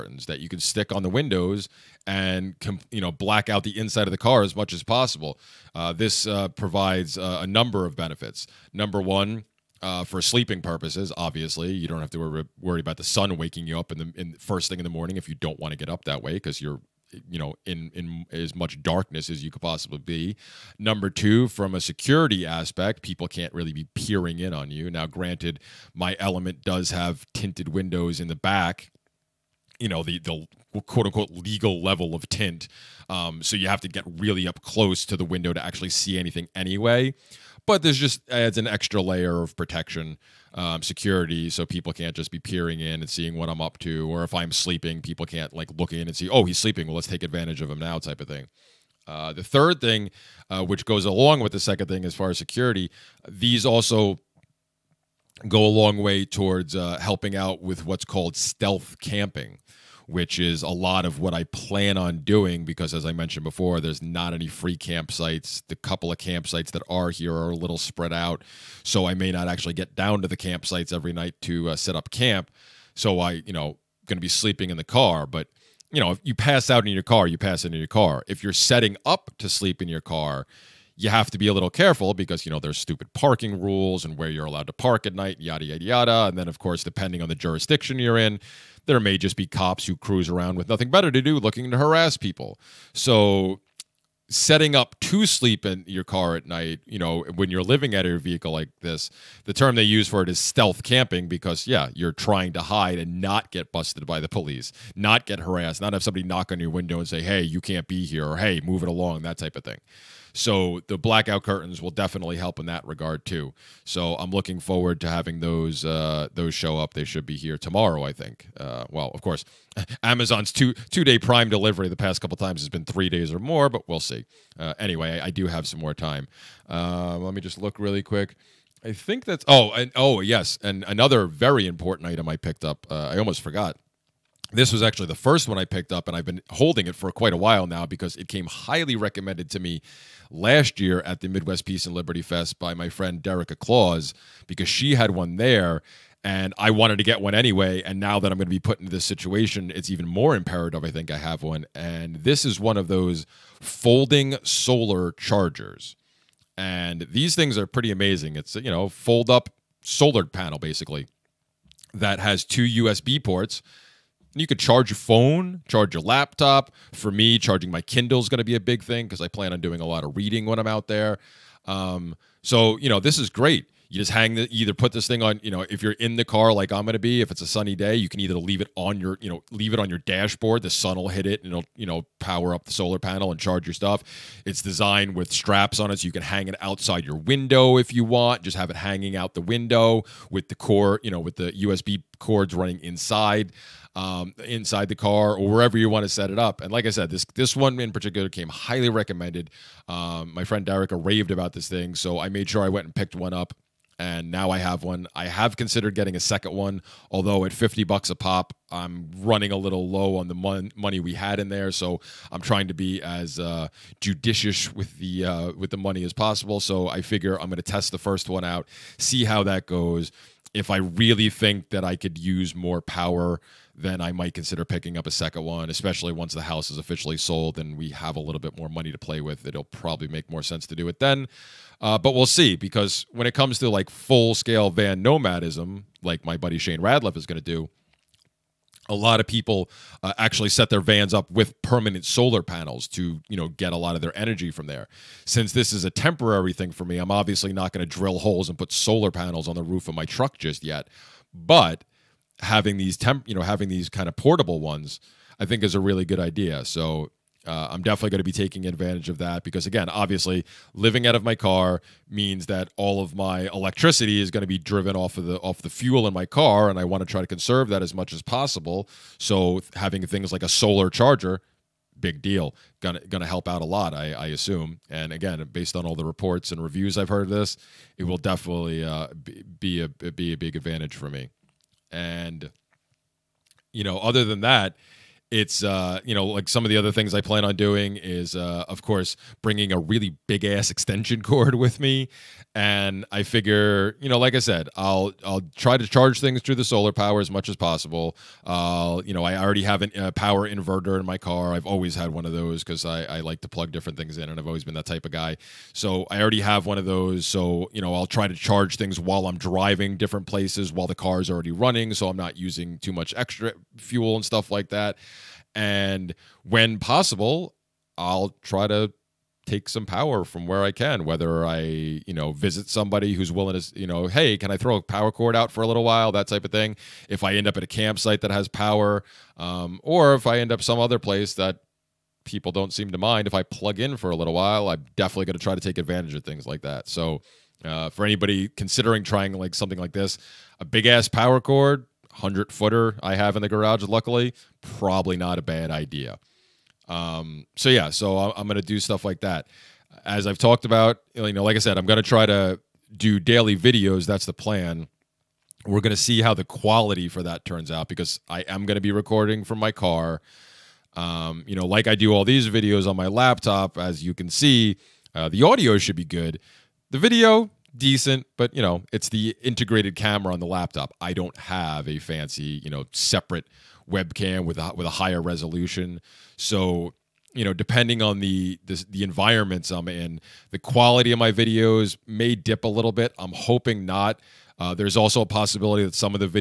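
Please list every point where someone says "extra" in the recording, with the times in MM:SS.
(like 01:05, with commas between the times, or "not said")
00:38, 05:13.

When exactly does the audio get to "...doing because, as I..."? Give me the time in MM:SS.
01:02.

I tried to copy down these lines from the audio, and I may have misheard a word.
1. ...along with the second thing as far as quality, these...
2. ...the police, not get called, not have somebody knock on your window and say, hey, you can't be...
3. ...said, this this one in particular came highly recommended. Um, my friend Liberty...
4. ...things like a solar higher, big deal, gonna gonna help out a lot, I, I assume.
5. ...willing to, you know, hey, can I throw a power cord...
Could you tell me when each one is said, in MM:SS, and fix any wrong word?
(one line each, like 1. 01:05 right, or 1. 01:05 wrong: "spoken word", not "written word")
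1. 00:51 wrong: "security", not "quality"
2. 01:44 wrong: "harassed", not "called"
3. 03:16 wrong: "Derek", not "Liberty"
4. 04:30 wrong: "charger", not "higher"
5. 05:23 right.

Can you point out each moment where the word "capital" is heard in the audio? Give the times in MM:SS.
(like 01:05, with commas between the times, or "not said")
not said.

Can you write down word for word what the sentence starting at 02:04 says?
Uh, anyway, I, I, do have some more time.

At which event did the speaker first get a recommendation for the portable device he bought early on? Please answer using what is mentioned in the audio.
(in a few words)
Midwest Peace and Liberty Fest.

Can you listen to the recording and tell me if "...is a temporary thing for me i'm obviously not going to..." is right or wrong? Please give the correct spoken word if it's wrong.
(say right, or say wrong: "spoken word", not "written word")
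right.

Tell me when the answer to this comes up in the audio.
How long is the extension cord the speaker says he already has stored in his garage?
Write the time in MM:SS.
05:42.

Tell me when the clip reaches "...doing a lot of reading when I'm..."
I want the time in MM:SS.
02:49.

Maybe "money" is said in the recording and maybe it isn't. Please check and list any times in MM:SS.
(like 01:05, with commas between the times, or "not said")
03:30, 03:35, 03:48.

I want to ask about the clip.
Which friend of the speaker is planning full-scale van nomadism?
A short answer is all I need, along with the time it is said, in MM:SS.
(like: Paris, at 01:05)
Shane Radliff, at 03:56.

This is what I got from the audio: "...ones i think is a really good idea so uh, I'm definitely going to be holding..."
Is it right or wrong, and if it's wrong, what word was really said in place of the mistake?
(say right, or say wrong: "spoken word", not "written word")
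wrong: "taking", not "holding".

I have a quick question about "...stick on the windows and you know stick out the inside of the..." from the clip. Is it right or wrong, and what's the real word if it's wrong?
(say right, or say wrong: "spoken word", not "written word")
wrong: "black", not "stick".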